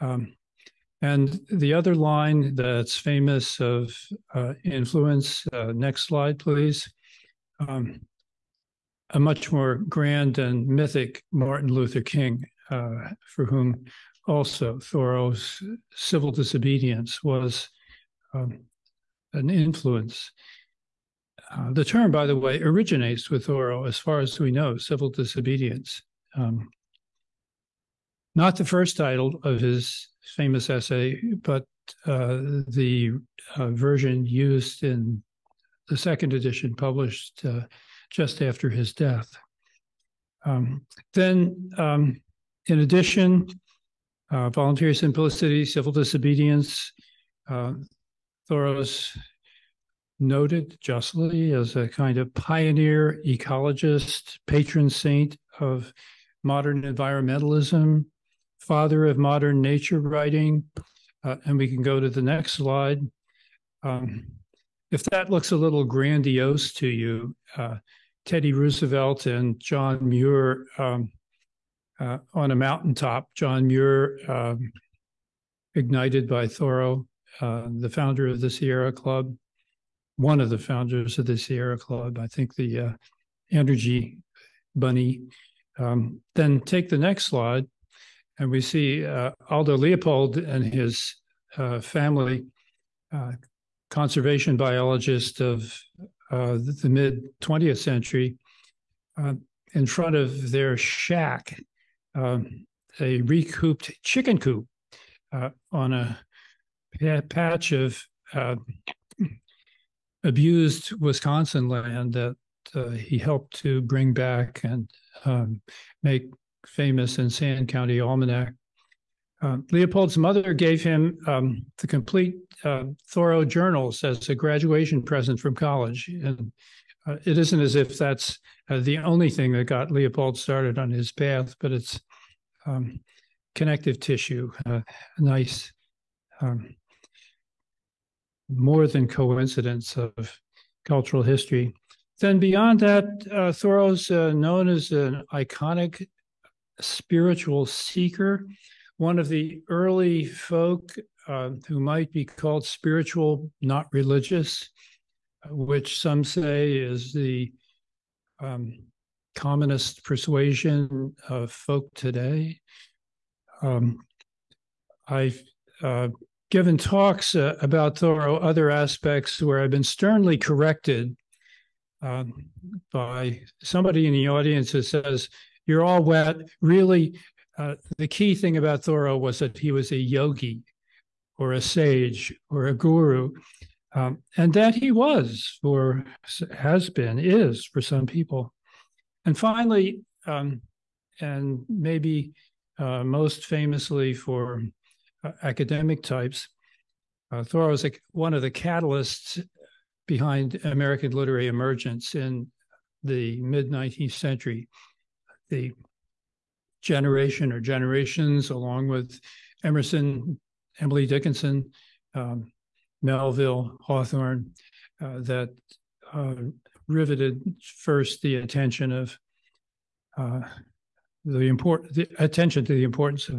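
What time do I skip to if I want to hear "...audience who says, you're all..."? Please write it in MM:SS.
02:54.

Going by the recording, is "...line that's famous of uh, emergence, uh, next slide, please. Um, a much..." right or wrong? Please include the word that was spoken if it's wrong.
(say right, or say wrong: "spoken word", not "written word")
wrong: "influence", not "emergence".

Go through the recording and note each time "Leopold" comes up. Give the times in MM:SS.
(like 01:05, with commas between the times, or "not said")
01:29, 01:59, 02:09.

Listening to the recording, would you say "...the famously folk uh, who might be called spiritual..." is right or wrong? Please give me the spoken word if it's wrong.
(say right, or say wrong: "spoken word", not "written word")
wrong: "early", not "famously".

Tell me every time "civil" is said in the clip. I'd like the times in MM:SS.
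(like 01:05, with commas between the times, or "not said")
00:15, 00:24, 00:45.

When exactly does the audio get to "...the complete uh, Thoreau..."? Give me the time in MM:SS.
02:01.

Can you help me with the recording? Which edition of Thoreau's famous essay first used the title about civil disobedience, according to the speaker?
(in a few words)
second edition.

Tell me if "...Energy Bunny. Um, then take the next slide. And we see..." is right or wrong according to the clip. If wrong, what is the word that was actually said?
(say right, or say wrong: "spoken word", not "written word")
right.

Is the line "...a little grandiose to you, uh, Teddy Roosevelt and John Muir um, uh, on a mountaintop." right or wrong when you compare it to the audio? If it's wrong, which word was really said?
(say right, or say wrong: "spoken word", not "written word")
right.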